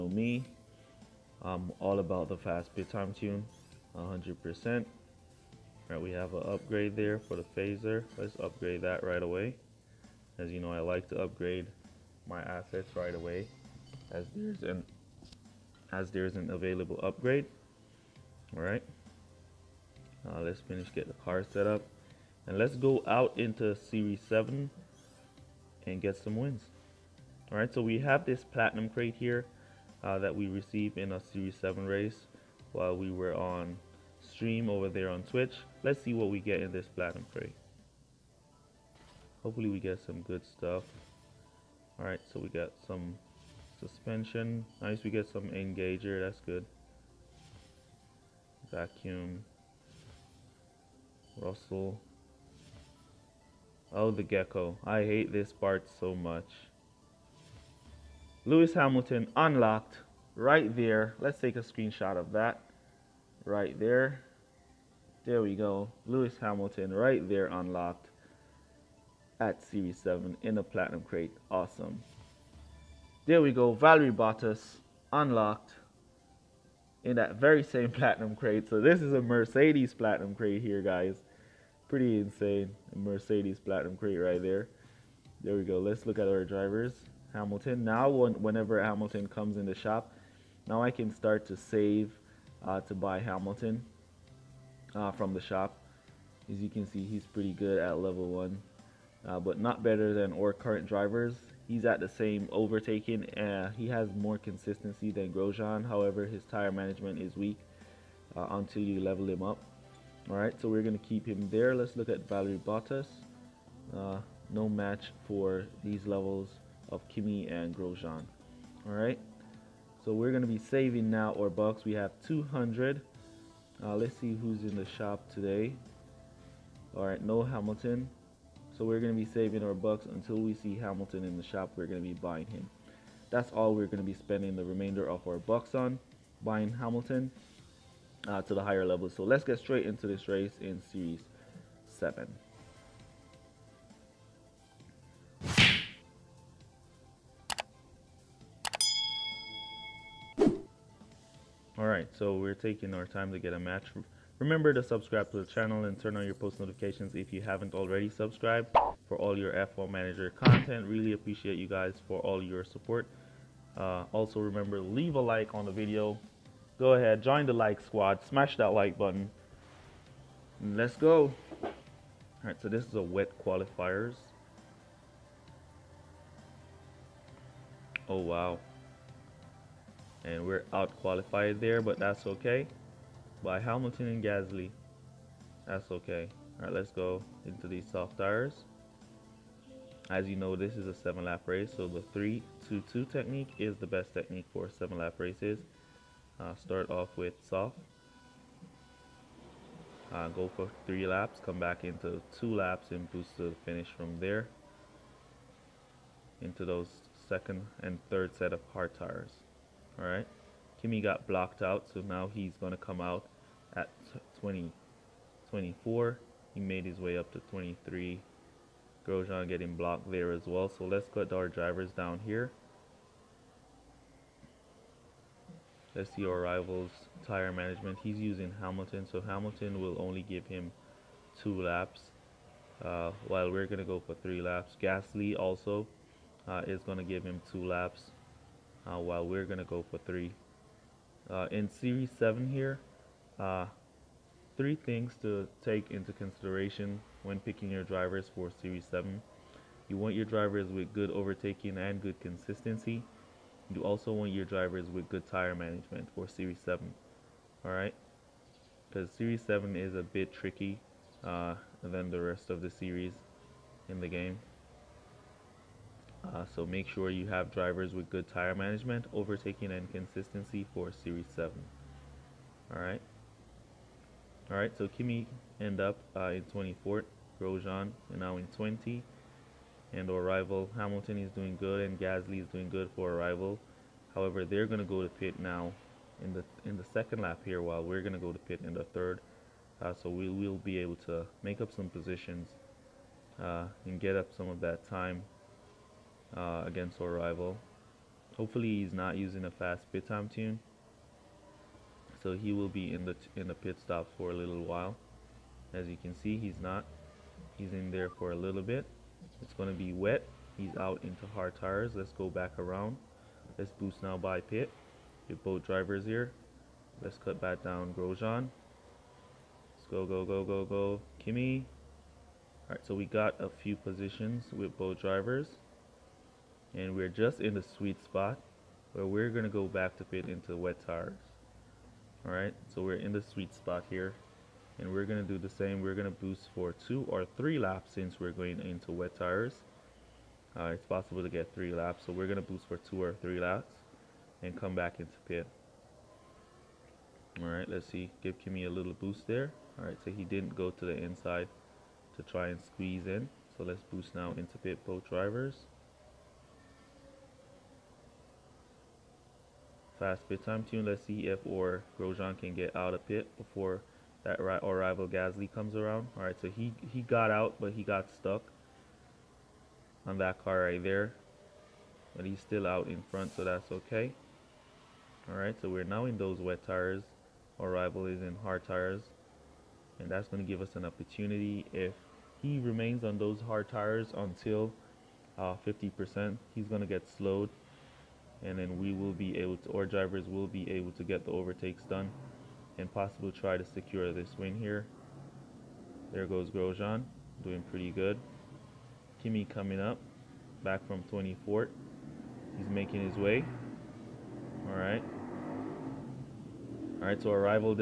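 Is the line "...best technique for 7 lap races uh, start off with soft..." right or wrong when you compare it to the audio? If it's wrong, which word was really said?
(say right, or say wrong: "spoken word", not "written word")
right.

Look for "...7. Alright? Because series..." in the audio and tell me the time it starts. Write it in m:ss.
4:16.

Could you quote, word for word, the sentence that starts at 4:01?
Uh, in series 7 here, uh, three things to take into consideration when picking your drivers for series 7.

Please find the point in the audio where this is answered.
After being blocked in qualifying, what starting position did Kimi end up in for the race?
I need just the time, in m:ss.
4:36.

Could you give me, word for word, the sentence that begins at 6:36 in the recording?
There goes Grosjean, doing pretty good.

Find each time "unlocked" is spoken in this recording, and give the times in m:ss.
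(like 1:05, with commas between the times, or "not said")
0:59, 1:07, 1:15.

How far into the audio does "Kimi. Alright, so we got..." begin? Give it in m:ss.
5:21.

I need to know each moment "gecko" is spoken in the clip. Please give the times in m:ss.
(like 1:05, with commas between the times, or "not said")
0:54.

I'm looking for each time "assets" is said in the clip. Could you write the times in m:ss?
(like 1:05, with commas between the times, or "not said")
0:12.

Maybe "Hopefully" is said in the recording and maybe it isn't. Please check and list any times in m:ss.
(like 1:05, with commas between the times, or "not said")
0:39, 4:58.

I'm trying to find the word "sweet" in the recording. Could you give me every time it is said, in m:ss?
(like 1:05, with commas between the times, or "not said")
5:27, 5:33.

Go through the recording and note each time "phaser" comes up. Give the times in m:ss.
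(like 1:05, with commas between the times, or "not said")
0:07.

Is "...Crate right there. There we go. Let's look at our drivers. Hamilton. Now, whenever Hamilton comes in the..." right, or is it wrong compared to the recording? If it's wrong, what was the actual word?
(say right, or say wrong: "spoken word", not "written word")
right.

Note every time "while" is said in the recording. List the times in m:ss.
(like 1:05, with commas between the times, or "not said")
0:32, 3:53, 3:58, 4:47, 5:04.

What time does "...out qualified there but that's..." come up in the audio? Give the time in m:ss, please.
3:00.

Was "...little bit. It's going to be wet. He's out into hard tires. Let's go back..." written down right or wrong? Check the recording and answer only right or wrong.
right.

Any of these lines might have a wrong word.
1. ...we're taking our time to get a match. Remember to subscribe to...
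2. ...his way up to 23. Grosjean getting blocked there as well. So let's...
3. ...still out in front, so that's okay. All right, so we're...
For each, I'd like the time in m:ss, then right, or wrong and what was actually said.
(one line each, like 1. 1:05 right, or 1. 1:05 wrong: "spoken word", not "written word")
1. 2:32 right
2. 3:36 right
3. 6:12 right.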